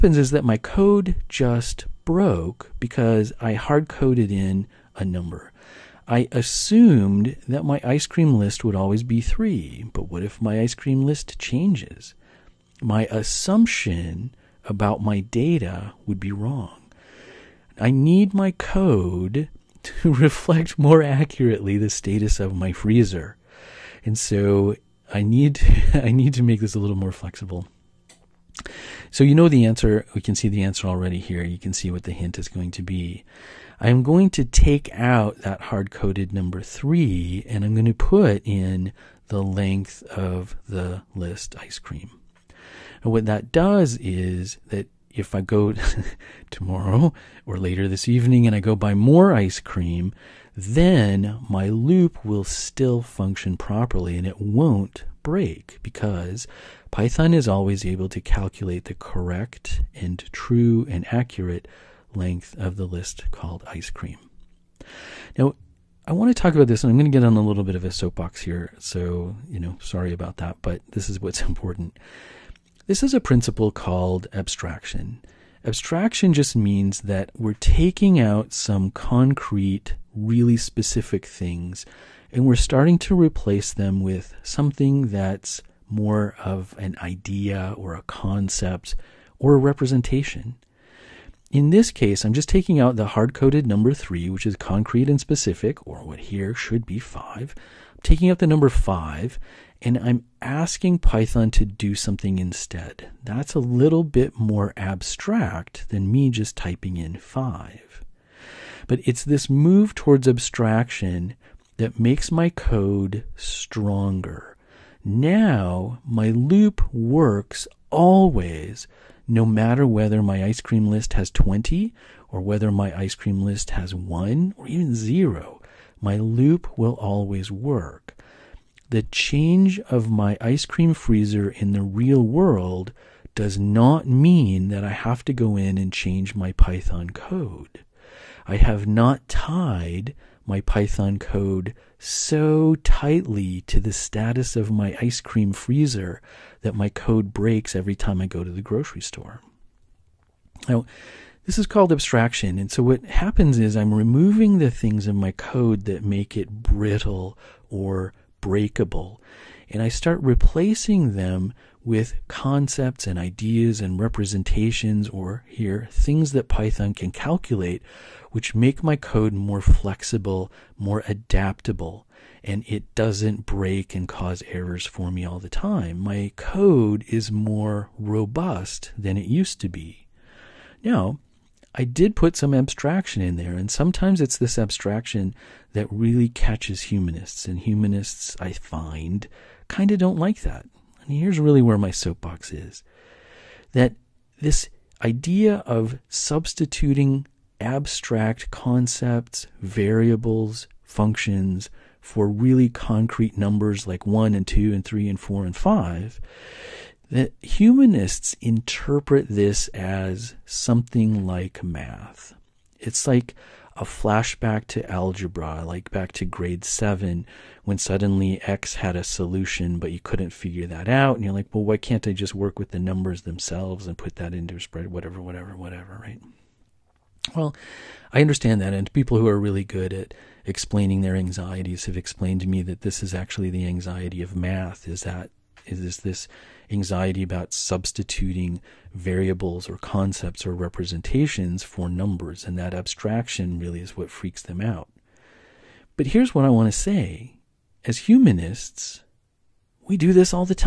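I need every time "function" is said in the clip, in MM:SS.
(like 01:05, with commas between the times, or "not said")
00:53, 03:20.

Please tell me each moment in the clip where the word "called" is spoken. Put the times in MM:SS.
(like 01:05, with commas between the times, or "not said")
01:03, 01:13, 02:31.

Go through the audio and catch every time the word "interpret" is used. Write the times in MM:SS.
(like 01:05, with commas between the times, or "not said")
03:28.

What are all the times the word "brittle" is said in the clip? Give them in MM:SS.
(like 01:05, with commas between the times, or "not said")
02:36.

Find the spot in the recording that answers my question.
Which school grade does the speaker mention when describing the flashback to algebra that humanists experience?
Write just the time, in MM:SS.
03:36.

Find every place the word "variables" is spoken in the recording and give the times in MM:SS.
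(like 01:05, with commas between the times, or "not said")
03:19, 03:58.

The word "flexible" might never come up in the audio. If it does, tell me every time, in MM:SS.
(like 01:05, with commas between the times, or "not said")
00:27, 02:49.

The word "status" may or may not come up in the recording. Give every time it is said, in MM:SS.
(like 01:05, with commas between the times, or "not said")
00:21, 02:23.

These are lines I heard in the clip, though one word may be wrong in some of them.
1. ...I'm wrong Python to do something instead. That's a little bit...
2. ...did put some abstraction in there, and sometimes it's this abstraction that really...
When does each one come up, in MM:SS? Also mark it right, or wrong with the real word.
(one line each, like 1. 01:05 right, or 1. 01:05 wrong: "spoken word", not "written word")
1. 01:39 wrong: "asking", not "wrong"
2. 03:01 right.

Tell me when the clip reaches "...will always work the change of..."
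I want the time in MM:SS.
02:06.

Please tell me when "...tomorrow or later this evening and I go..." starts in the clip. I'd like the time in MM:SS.
00:46.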